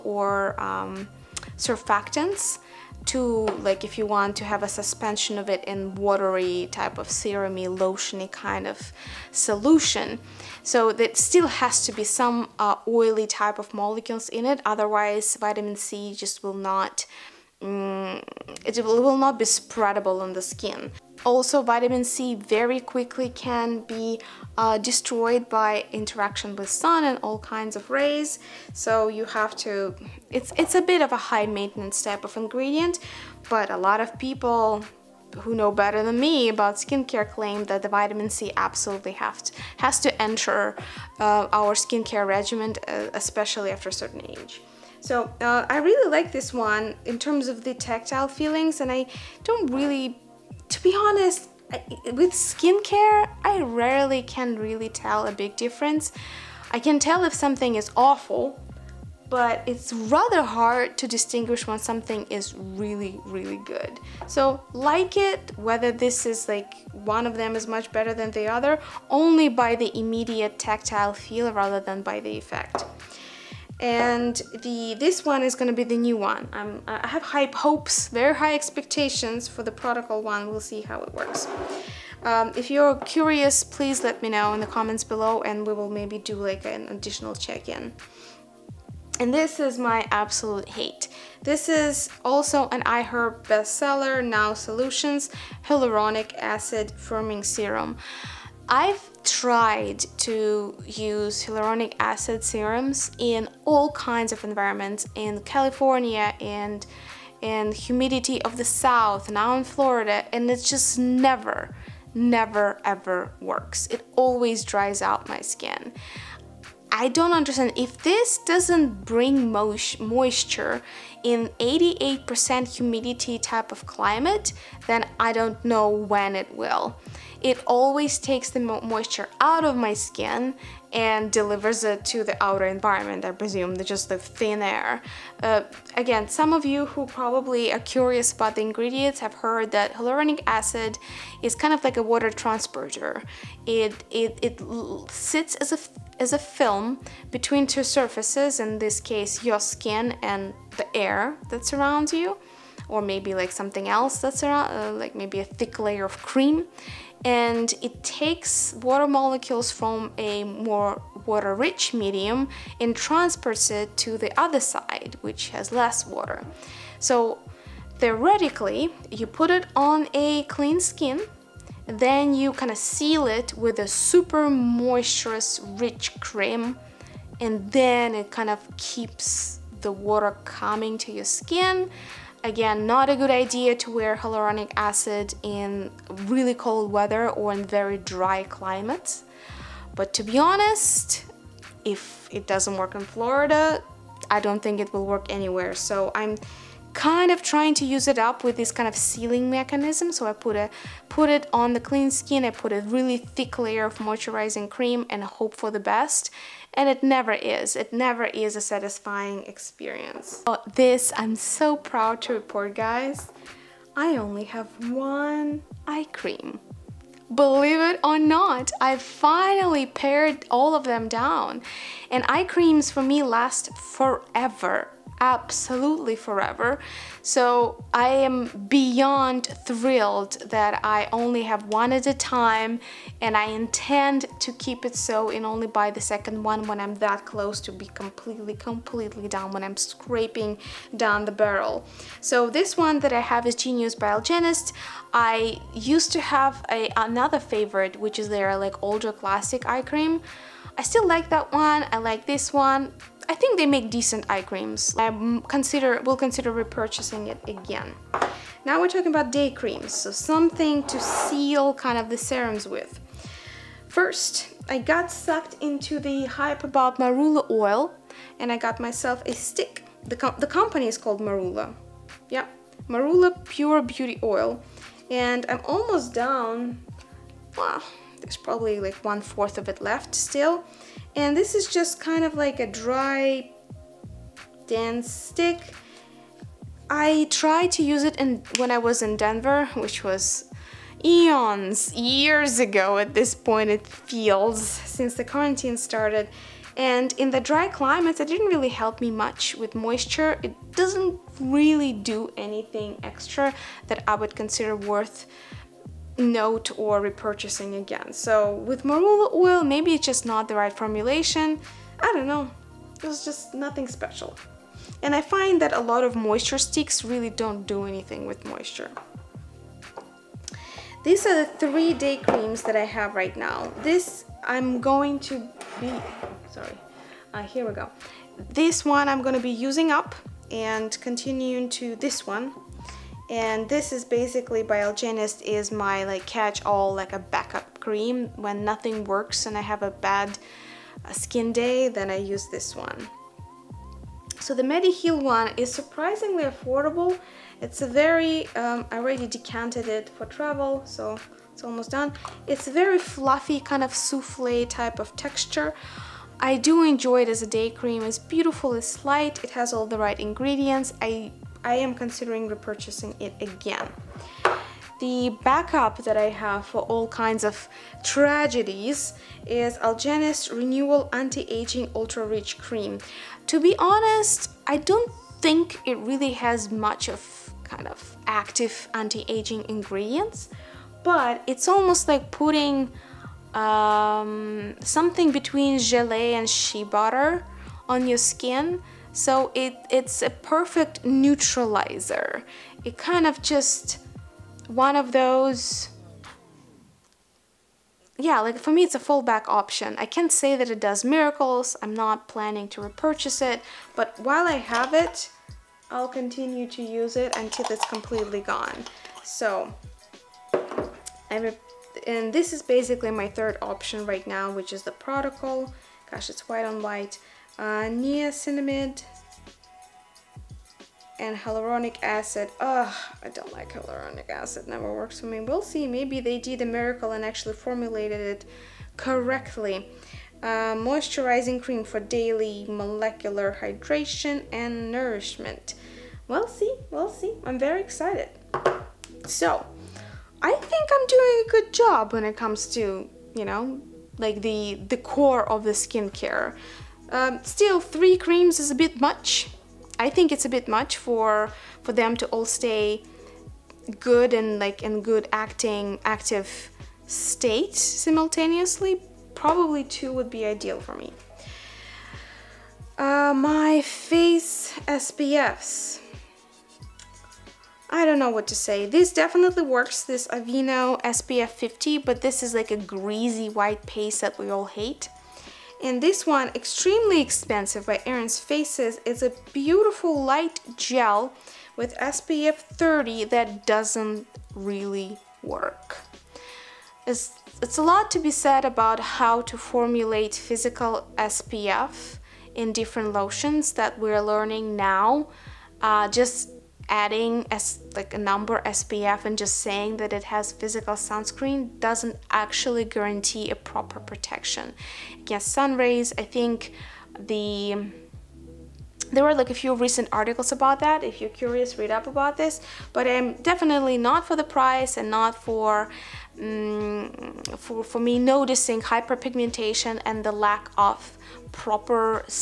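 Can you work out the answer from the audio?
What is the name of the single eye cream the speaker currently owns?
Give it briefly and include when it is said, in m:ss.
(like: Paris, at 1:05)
Genius, at 4:03.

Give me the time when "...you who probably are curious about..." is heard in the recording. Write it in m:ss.
2:16.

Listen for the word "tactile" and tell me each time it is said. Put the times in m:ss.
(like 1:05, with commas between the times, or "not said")
0:47, 1:10.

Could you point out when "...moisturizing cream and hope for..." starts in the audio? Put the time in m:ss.
3:23.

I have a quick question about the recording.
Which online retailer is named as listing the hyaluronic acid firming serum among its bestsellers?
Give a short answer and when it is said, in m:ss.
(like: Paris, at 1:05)
iHerb, at 1:32.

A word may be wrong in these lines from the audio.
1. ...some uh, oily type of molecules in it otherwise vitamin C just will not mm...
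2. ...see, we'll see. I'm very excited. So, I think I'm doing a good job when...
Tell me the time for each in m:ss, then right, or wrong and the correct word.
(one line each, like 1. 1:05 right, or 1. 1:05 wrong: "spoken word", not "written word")
1. 0:12 right
2. 7:16 right.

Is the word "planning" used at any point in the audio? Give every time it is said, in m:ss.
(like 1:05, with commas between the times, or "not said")
6:42.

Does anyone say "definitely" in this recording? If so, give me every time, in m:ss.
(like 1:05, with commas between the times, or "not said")
7:49, 8:33.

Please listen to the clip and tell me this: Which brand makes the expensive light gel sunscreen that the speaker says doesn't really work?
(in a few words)
Erin's Faces.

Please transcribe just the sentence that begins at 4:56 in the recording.
And in the dry climates, it didn't really help me much with moisture.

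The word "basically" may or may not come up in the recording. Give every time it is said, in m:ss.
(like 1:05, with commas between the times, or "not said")
5:34, 6:52.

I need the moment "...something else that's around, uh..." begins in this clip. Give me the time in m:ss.
2:33.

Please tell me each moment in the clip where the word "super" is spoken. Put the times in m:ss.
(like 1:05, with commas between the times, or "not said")
2:53.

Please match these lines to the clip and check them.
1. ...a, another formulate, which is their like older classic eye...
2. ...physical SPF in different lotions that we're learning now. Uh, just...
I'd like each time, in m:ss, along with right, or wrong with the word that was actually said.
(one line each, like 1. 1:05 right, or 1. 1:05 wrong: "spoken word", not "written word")
1. 4:06 wrong: "favorite", not "formulate"
2. 8:10 right.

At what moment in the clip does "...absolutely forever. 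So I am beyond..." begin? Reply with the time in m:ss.
3:45.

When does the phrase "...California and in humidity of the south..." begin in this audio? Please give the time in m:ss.
1:45.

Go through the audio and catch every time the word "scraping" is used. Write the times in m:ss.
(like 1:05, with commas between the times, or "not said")
3:59.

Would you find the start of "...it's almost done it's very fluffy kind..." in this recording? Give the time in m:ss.
5:51.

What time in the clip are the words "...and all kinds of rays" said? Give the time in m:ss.
0:27.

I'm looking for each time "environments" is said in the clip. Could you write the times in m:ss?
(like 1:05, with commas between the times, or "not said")
1:44, 2:12.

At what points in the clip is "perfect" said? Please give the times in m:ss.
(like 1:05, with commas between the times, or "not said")
6:30.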